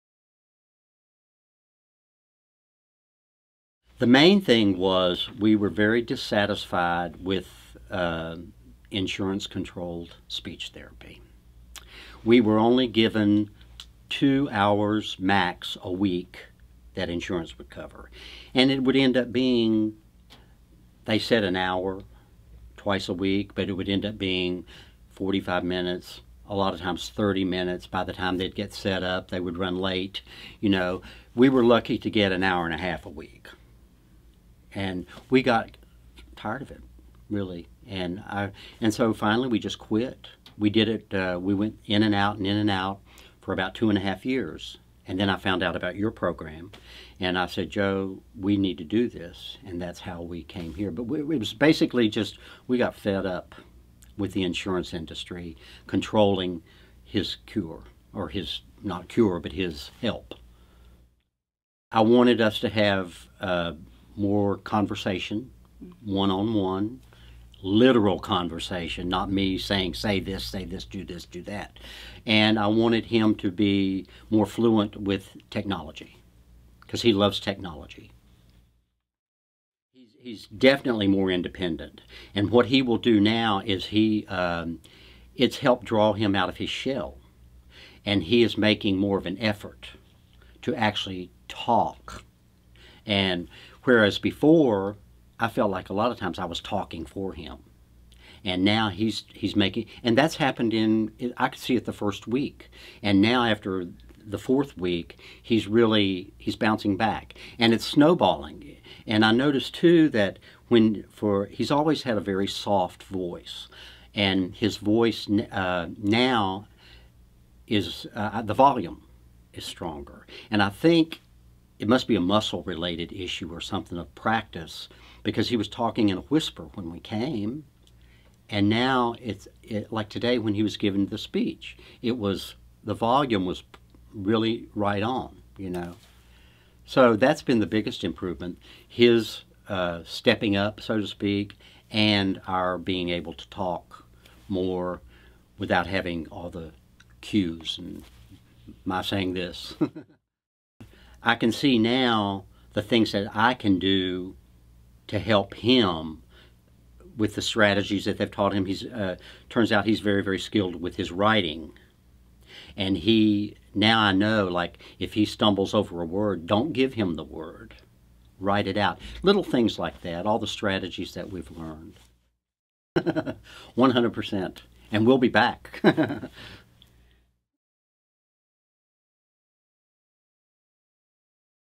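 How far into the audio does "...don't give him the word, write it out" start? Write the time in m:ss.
2:46.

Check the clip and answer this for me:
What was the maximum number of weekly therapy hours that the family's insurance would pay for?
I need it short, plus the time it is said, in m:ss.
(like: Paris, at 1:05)
2 hours, at 0:14.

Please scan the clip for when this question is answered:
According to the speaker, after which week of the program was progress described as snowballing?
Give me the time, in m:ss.
1:44.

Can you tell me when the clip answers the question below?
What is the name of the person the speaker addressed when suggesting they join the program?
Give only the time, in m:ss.
0:47.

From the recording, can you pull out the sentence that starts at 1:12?
And I wanted him to be more fluent with technology because he loves technology.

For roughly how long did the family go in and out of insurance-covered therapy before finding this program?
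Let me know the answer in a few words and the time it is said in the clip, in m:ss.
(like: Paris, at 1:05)
2 and a half years, at 0:43.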